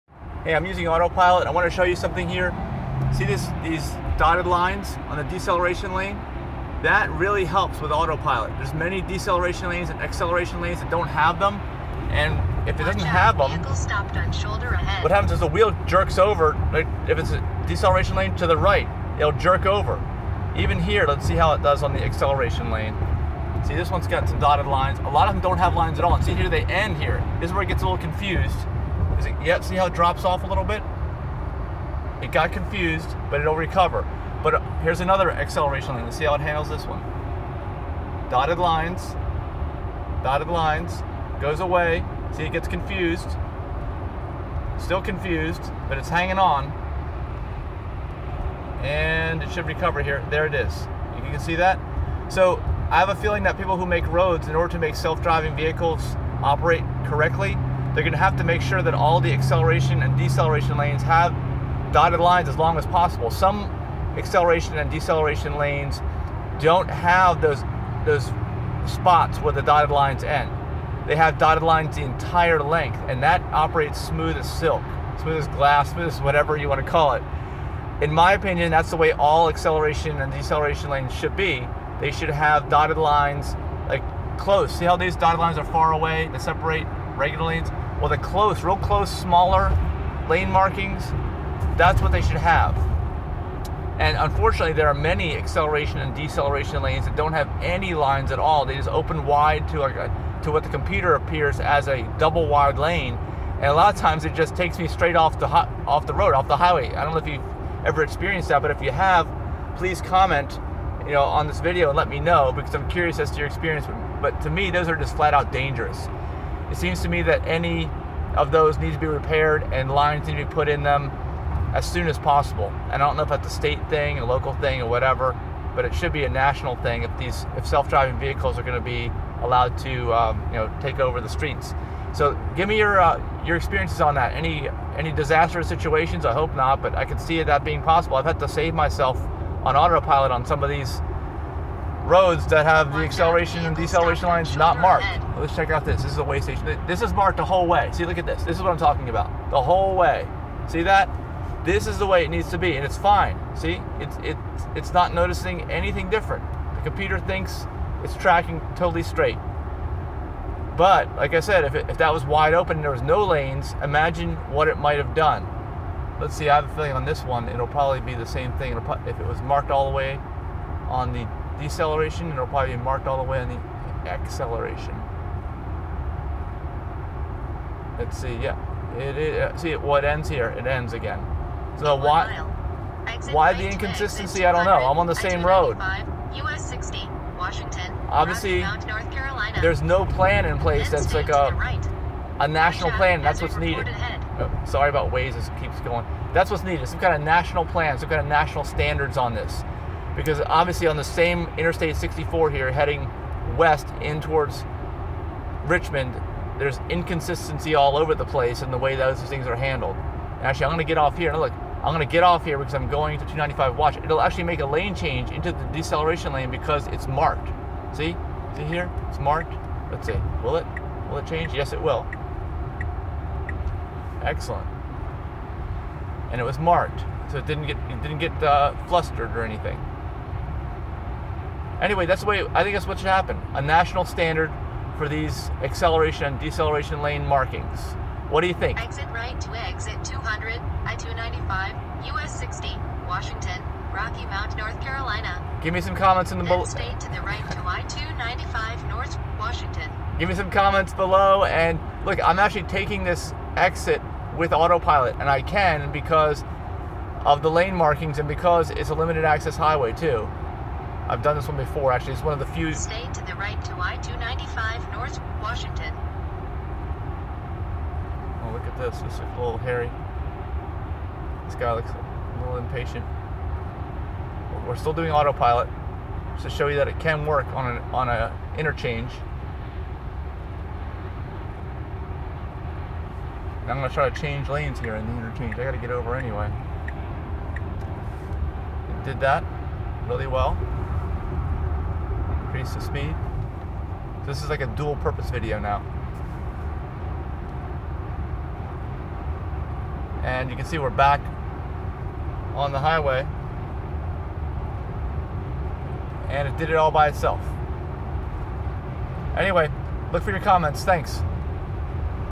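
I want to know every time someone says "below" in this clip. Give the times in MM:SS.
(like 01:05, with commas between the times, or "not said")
04:06, 04:10.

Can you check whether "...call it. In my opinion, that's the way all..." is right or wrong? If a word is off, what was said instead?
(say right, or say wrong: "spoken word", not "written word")
right.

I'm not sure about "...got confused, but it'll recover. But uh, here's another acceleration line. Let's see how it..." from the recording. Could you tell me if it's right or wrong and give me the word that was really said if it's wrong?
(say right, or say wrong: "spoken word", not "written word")
right.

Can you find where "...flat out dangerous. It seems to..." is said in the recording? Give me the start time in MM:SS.
01:55.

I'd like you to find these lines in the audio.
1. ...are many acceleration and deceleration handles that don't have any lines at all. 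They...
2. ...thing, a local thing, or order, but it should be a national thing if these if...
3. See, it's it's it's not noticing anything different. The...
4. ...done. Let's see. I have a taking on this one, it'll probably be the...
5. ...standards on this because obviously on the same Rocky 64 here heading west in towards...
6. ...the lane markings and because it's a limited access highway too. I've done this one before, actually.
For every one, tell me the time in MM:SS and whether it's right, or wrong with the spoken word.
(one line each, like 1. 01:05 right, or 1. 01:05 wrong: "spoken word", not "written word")
1. 01:34 wrong: "lanes", not "handles"
2. 02:03 wrong: "whatever", not "order"
3. 02:33 right
4. 02:45 wrong: "feeling", not "taking"
5. 03:18 wrong: "Interstate", not "Rocky"
6. 04:17 right.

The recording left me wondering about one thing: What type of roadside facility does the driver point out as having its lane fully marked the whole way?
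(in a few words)
A way station.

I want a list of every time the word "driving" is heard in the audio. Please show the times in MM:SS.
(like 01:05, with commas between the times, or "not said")
00:54, 02:07.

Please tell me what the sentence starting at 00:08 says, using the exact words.
There's many deceleration lanes and acceleration lanes that don't have them.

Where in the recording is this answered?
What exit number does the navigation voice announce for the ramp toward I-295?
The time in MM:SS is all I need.
04:00.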